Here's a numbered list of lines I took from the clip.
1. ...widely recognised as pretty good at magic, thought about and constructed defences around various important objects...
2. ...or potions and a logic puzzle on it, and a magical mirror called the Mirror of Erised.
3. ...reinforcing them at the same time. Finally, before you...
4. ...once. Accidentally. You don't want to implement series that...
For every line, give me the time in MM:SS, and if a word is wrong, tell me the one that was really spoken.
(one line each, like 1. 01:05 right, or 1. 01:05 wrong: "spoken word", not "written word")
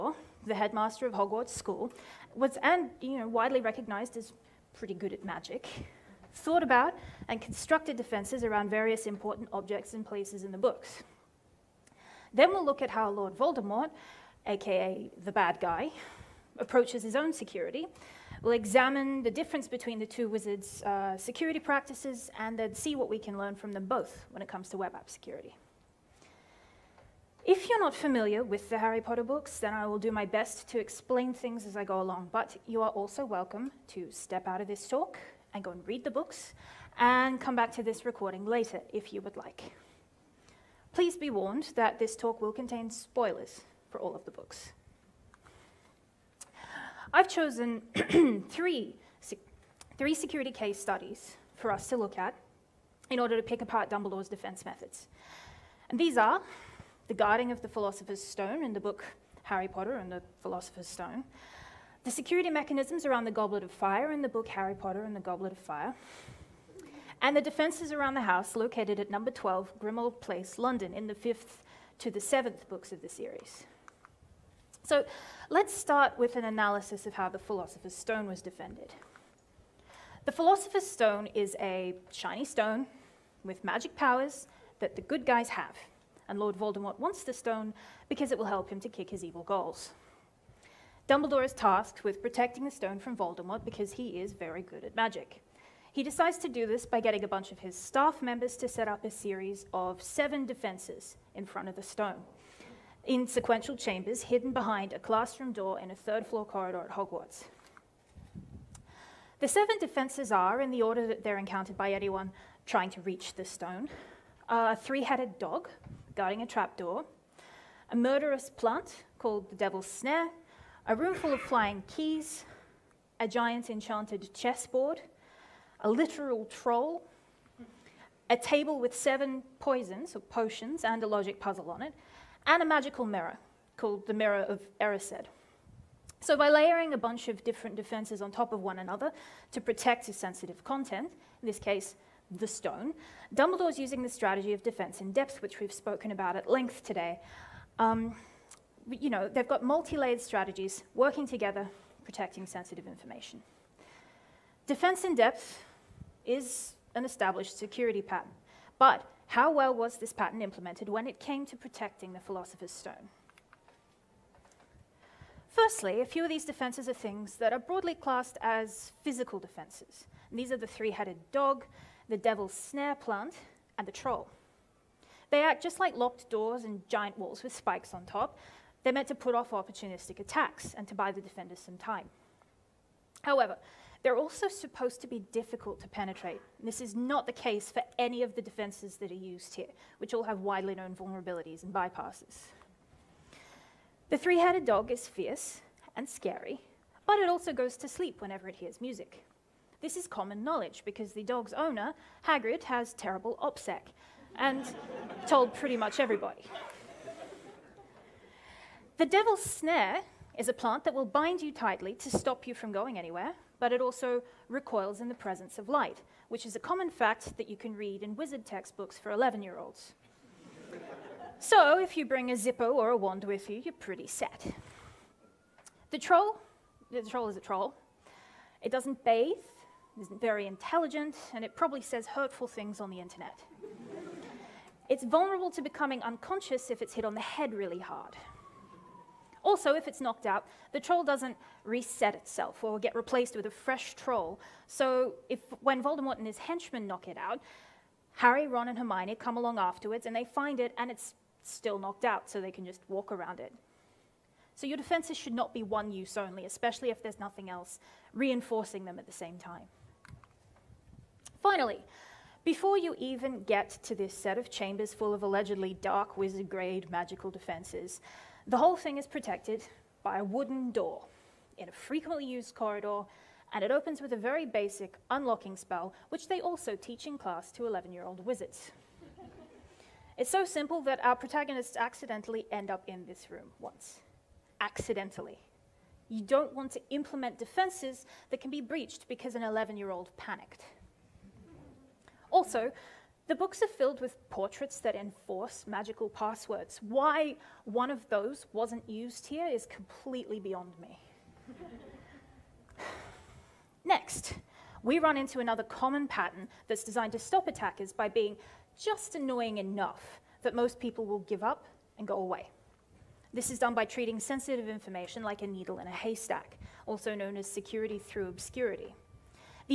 1. 00:03 right
2. 02:10 right
3. 04:18 right
4. 04:43 wrong: "defenses", not "series".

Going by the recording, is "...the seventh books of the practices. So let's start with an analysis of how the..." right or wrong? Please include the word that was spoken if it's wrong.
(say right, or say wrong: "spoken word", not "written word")
wrong: "series", not "practices".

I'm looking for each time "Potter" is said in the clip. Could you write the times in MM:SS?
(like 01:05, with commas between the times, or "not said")
00:28, 00:59, 01:04.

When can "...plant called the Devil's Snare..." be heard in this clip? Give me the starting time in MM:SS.
01:58.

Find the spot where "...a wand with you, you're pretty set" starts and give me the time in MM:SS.
03:42.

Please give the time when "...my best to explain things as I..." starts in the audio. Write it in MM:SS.
00:30.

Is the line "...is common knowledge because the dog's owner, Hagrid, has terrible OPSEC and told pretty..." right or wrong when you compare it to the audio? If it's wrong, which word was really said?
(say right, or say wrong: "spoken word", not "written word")
right.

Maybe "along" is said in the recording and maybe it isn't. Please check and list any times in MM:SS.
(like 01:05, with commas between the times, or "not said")
00:31, 04:09.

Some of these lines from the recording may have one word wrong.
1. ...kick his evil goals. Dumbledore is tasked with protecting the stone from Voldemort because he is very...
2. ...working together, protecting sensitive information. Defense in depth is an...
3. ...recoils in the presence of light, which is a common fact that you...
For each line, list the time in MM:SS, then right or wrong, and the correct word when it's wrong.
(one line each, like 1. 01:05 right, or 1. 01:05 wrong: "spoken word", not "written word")
1. 01:28 right
2. 02:30 right
3. 03:34 right.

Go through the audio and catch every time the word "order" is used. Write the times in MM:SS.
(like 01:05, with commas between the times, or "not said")
00:53, 01:50.